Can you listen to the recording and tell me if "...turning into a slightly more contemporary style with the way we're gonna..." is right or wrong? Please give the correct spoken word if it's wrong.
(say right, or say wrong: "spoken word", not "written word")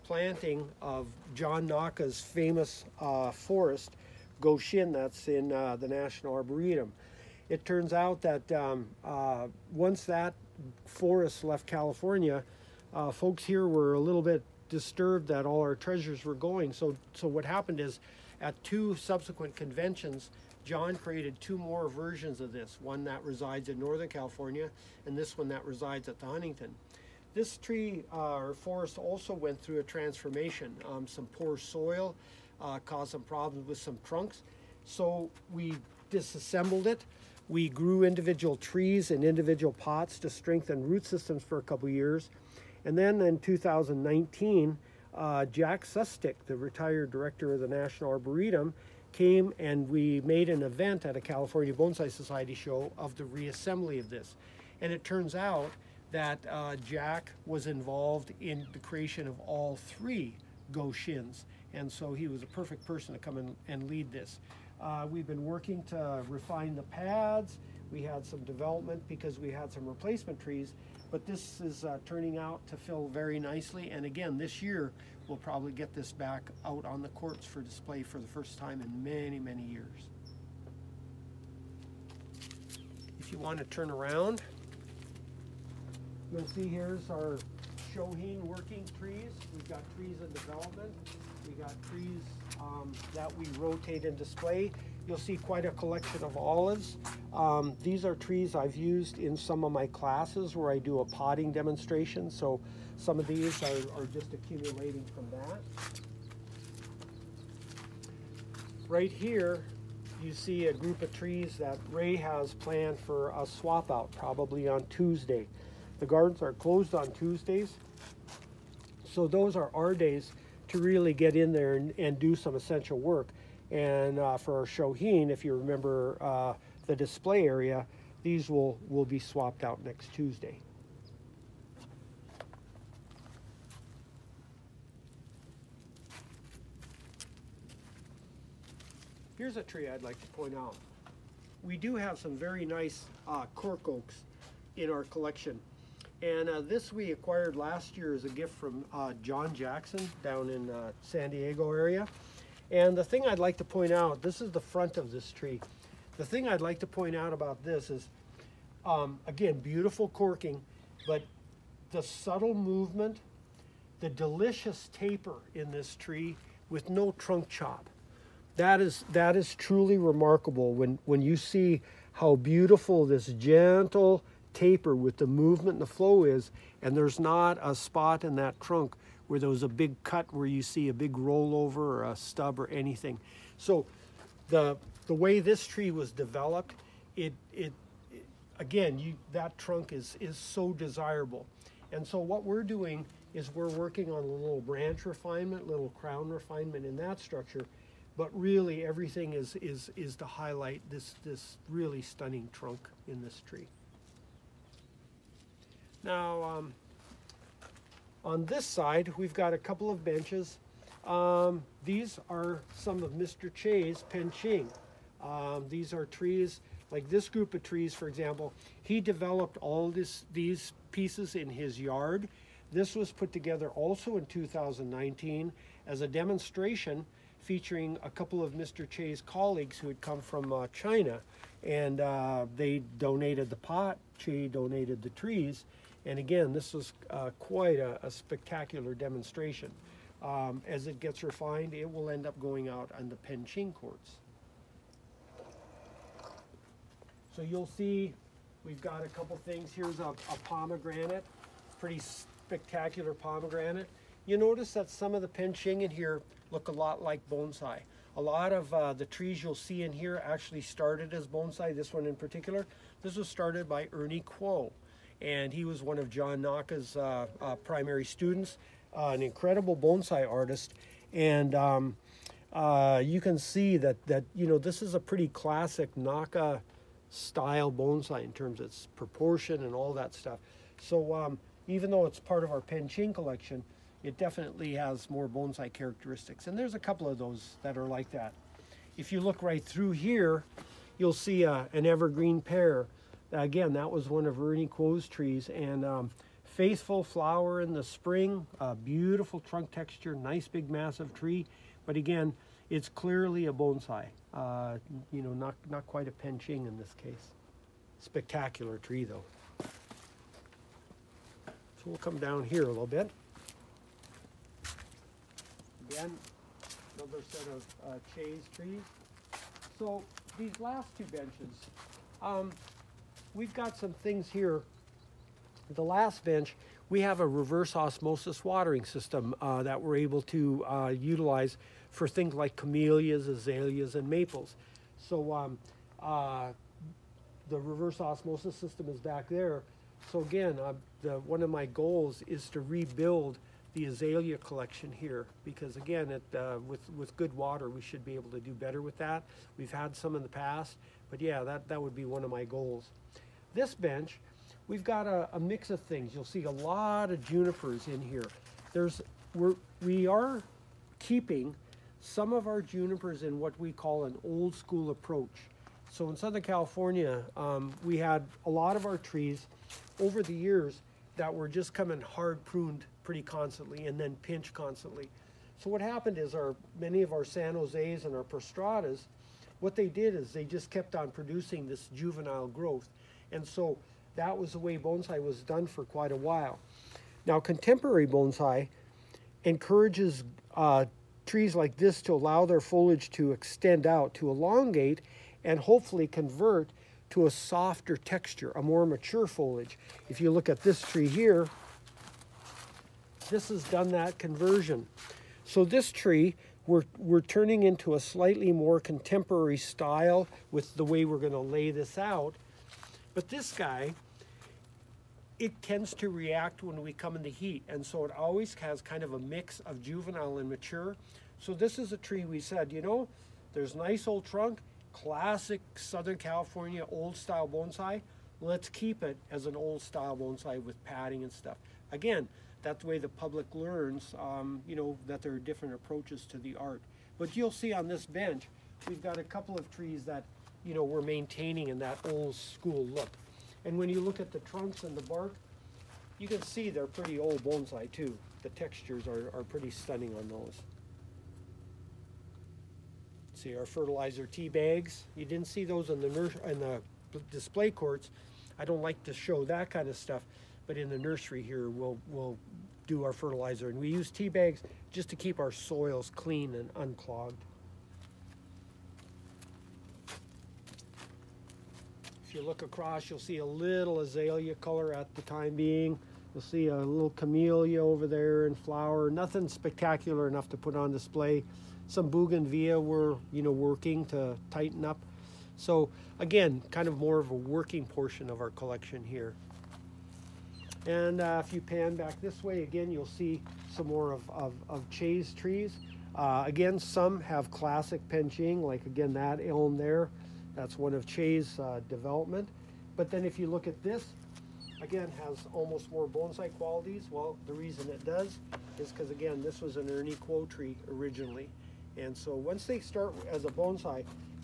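right.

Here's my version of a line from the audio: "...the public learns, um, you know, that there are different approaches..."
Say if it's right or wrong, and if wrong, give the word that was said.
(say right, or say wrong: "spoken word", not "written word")
right.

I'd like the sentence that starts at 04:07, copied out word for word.
So you'll see we've got a couple things.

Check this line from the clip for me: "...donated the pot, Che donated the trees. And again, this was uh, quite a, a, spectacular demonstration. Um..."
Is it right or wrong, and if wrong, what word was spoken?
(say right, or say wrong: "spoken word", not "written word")
right.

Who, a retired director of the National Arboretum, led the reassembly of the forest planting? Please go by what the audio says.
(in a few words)
Jack Sustic.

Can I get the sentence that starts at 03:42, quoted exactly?
This was put together also in 2019 as a demonstration featuring a couple of Mr.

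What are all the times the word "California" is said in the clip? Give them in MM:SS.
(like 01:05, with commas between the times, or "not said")
00:11, 00:24, 00:51, 06:06, 07:06.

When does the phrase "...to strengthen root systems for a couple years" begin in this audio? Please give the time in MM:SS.
00:40.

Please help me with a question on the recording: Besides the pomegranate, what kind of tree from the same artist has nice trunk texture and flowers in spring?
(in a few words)
evergreen pear.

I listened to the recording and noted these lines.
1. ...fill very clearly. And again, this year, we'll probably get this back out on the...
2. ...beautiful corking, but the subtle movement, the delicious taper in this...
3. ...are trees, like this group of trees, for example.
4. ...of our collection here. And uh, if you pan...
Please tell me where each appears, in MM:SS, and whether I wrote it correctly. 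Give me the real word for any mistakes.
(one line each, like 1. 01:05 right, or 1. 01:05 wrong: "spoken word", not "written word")
1. 01:12 wrong: "nicely", not "clearly"
2. 02:39 right
3. 03:35 right
4. 08:08 right.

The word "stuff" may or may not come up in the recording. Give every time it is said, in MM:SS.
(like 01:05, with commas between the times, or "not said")
04:40, 07:11, 07:39.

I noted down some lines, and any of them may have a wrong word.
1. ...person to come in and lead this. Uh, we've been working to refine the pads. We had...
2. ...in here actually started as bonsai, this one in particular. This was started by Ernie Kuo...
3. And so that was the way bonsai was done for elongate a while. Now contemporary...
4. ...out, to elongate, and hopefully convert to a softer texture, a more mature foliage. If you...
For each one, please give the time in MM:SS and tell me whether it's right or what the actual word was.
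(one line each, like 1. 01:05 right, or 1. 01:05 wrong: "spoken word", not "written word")
1. 01:02 right
2. 04:19 right
3. 06:23 wrong: "quite", not "elongate"
4. 06:33 right.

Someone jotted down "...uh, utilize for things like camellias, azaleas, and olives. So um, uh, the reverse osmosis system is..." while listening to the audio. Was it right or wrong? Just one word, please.
wrong.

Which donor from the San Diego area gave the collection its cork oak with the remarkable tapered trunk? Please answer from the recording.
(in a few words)
John Jackson.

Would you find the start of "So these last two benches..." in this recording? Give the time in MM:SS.
05:19.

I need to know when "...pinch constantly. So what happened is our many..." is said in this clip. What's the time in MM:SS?
06:14.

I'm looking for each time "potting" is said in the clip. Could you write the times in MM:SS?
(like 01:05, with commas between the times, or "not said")
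01:41.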